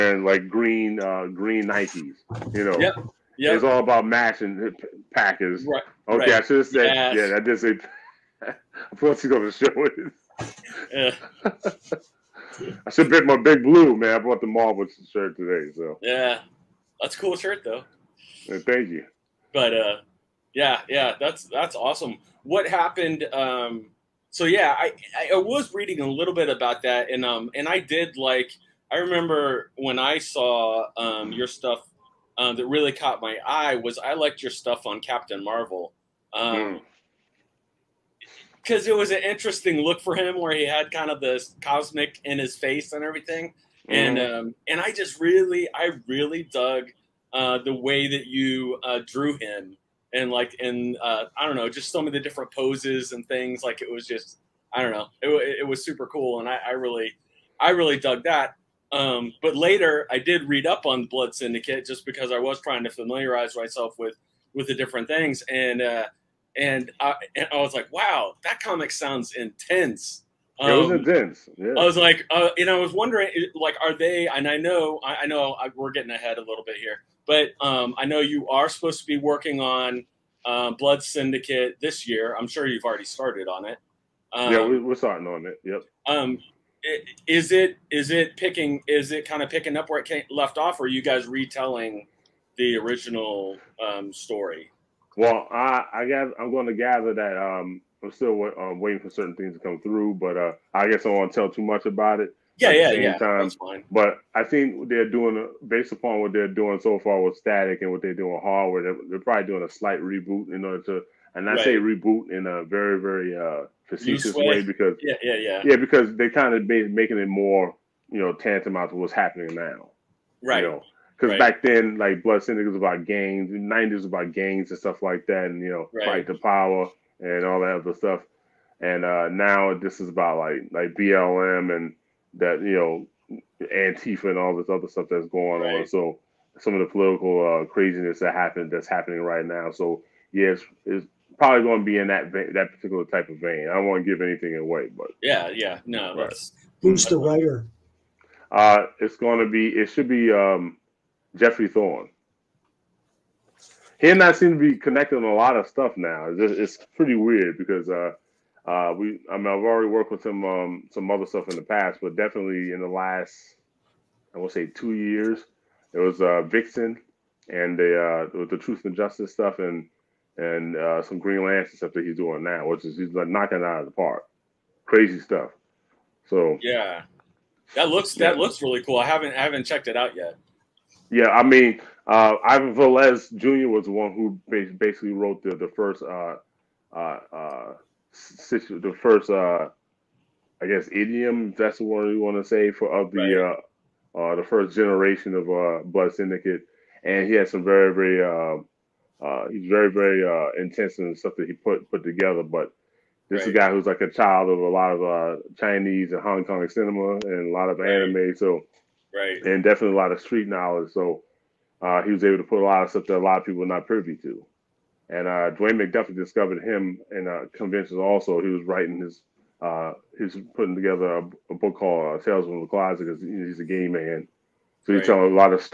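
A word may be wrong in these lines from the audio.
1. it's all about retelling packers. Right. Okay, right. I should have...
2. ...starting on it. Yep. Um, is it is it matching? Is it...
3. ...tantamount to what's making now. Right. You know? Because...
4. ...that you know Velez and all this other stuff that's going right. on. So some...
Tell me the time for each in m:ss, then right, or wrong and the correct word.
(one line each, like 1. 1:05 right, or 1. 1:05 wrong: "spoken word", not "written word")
1. 0:03 wrong: "matching", not "retelling"
2. 1:24 wrong: "picking", not "matching"
3. 1:58 wrong: "happening", not "making"
4. 2:12 wrong: "Antifa", not "Velez".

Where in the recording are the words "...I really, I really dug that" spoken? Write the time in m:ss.
0:56.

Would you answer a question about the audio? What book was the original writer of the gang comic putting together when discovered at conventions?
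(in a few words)
Tales from the Closet.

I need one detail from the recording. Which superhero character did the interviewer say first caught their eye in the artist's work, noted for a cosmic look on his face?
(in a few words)
Captain Marvel.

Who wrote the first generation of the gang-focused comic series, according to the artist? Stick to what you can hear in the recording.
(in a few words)
Ivan Velez Jr.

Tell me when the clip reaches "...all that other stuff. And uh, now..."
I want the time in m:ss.
2:07.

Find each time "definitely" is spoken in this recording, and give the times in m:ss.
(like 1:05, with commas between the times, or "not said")
2:42, 3:29.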